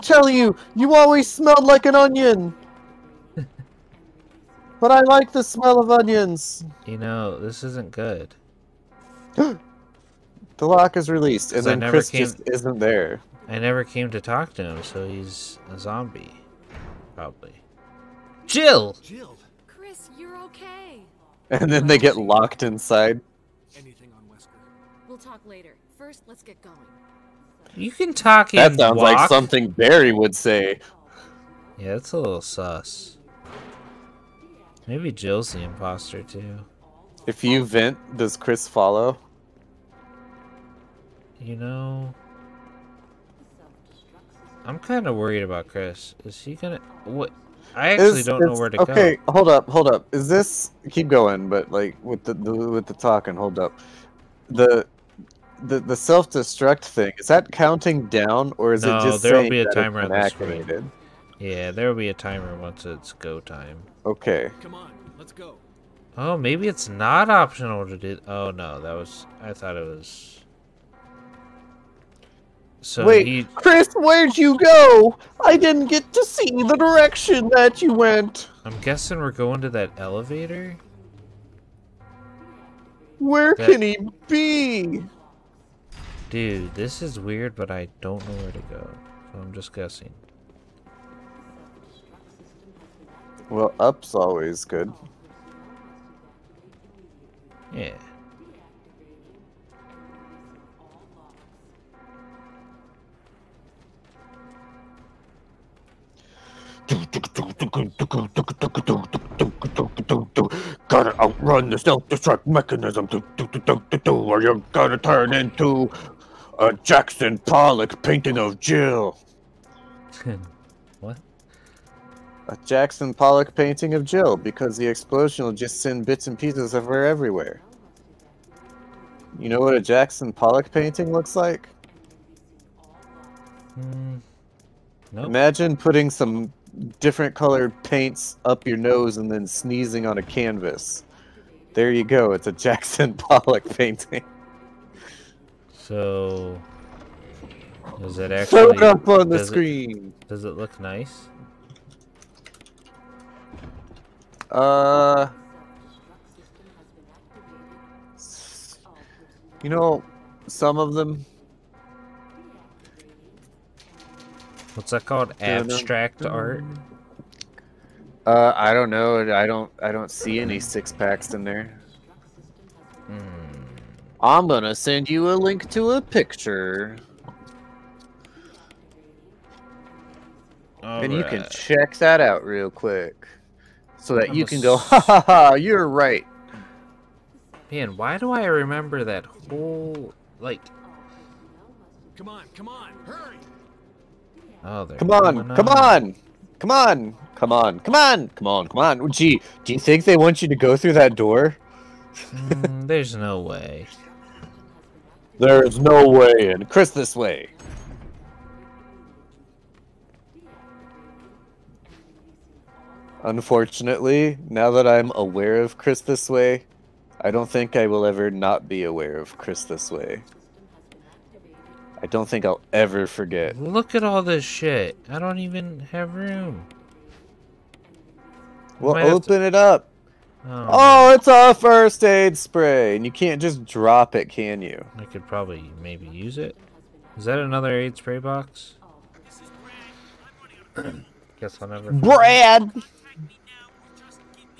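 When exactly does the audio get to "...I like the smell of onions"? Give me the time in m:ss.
0:04.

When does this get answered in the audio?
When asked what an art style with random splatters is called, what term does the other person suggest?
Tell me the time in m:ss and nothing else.
2:45.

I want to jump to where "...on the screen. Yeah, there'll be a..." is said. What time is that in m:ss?
1:00.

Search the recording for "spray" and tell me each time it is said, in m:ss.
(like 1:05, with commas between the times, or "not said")
3:52, 3:57.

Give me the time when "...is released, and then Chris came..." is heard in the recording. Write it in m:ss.
0:10.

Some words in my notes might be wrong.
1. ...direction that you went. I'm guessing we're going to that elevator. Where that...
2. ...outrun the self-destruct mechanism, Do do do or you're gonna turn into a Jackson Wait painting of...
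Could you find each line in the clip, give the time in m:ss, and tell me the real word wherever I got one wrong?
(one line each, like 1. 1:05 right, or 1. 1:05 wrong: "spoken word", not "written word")
1. 1:16 right
2. 1:51 wrong: "Pollock", not "Wait".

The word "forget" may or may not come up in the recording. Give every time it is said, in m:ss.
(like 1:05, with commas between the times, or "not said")
3:43.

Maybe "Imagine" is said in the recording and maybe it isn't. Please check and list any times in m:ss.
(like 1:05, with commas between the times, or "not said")
2:15.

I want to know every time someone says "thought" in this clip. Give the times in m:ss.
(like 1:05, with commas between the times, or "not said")
1:09.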